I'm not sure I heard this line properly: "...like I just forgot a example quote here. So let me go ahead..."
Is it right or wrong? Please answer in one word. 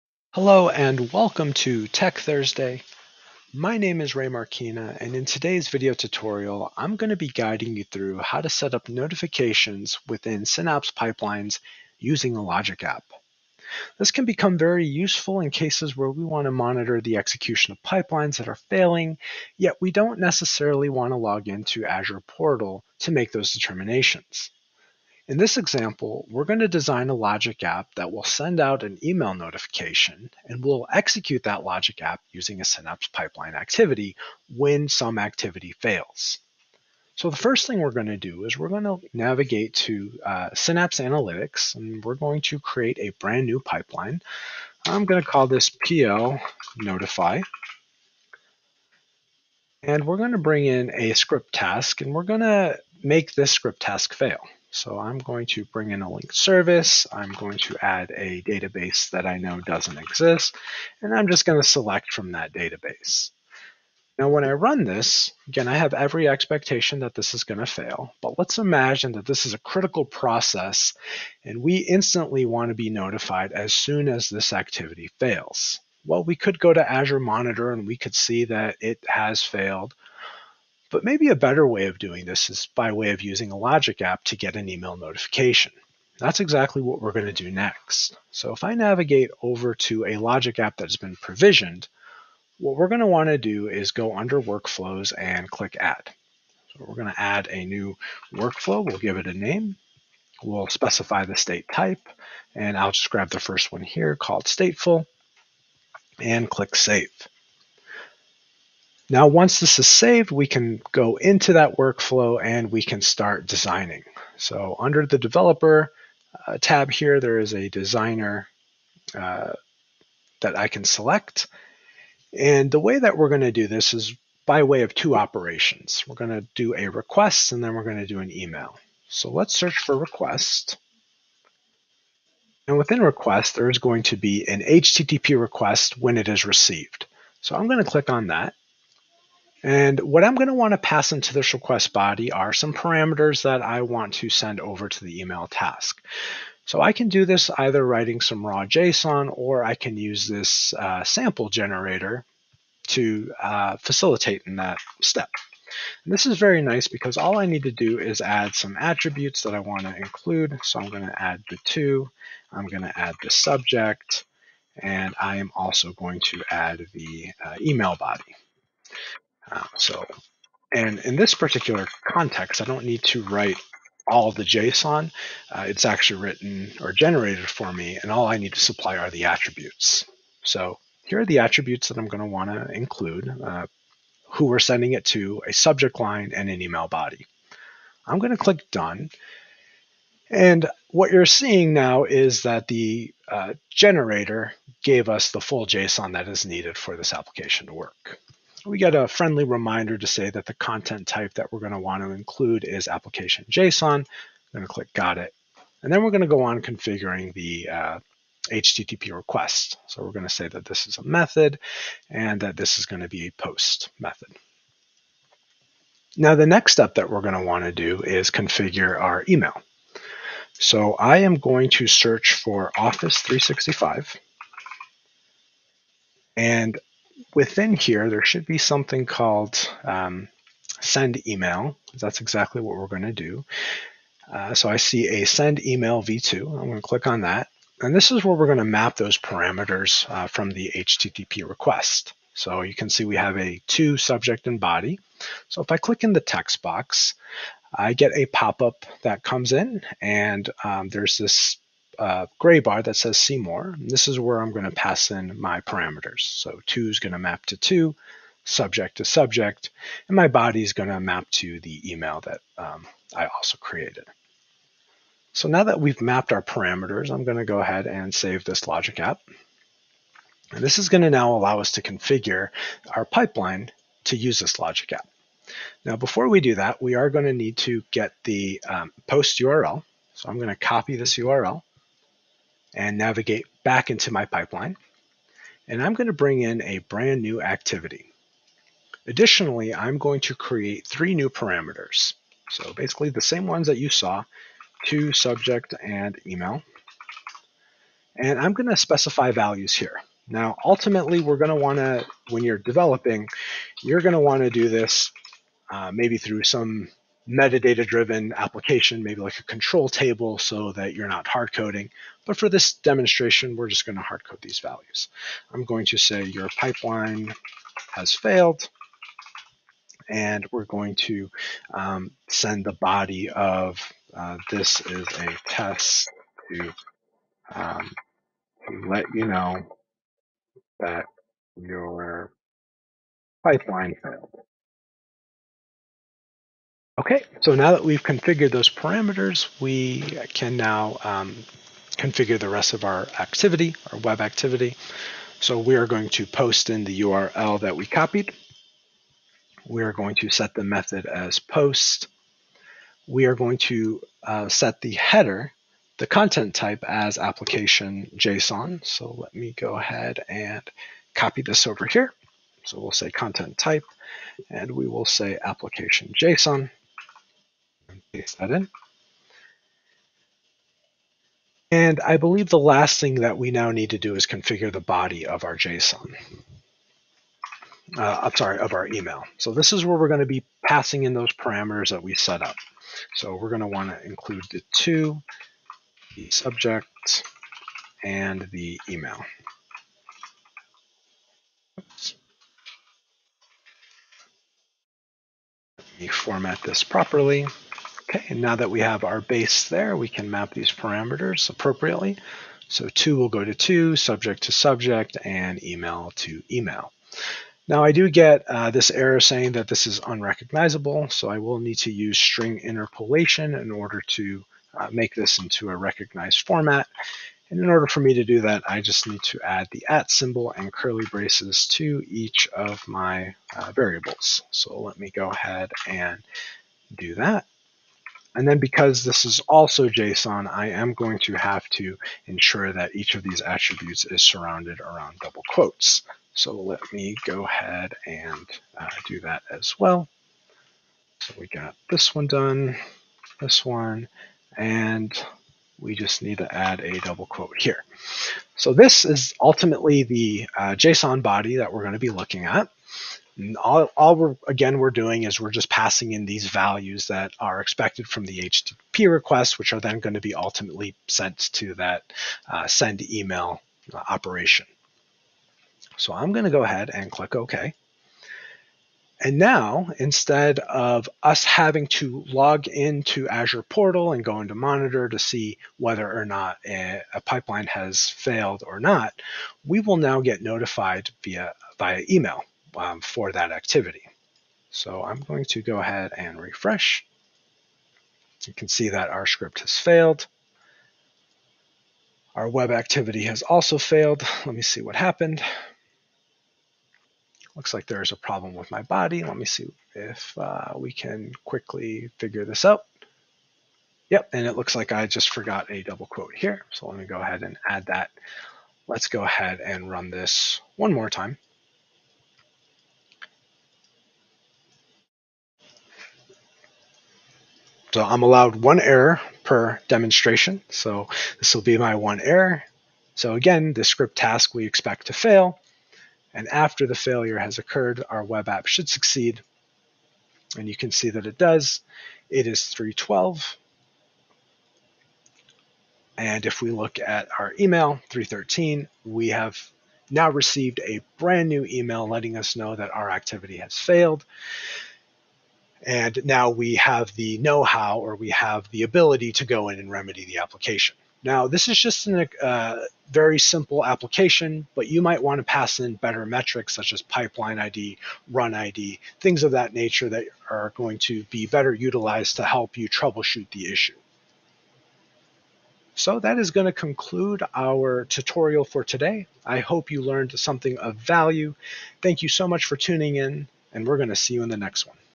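wrong.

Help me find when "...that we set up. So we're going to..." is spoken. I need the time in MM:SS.
06:21.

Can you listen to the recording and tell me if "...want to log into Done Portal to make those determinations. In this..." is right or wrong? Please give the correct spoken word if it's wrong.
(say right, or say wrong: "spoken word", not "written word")
wrong: "Azure", not "Done".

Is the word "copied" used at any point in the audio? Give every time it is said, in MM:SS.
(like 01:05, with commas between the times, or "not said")
05:47.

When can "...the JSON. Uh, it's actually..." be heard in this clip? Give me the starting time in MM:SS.
02:54.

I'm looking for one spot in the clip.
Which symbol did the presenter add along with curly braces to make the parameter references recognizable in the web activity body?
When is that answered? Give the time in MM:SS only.
06:59.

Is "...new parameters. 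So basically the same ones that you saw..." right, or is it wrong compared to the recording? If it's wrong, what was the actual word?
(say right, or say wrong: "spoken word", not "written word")
right.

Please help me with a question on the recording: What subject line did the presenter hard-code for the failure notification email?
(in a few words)
your pipeline has failed.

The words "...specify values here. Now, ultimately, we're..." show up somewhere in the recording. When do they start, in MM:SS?
04:58.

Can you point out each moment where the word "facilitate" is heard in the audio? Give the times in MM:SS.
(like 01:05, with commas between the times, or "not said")
02:33.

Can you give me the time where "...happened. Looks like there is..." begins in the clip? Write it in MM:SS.
08:14.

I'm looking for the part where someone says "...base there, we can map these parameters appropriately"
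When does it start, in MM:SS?
06:39.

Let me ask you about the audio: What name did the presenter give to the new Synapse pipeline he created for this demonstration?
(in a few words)
PO notify.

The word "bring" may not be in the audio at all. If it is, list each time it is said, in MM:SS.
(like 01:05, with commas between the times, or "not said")
00:50, 00:55, 04:46.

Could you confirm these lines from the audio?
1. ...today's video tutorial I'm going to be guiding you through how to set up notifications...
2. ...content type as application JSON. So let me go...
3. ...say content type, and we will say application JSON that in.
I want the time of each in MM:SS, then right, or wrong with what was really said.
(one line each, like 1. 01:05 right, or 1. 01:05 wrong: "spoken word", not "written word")
1. 00:05 right
2. 05:56 right
3. 06:02 right.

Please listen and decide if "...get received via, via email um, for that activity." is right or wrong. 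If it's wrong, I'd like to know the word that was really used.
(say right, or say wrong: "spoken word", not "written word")
wrong: "notified", not "received".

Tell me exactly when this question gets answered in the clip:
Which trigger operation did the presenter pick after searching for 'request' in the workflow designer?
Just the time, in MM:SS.
02:14.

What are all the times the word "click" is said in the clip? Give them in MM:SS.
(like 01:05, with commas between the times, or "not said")
01:35, 01:46, 02:17, 03:08, 03:24, 03:56, 04:05, 07:47.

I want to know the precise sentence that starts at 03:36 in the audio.
Now the next step that we're going to want to do is configure our email.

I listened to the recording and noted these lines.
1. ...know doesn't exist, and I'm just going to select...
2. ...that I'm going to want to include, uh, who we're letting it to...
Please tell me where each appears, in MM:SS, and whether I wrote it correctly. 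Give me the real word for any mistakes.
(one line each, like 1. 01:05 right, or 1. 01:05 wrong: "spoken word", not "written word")
1. 00:59 right
2. 03:01 wrong: "sending", not "letting".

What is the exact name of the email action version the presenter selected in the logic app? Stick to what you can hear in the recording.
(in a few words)
send email v2.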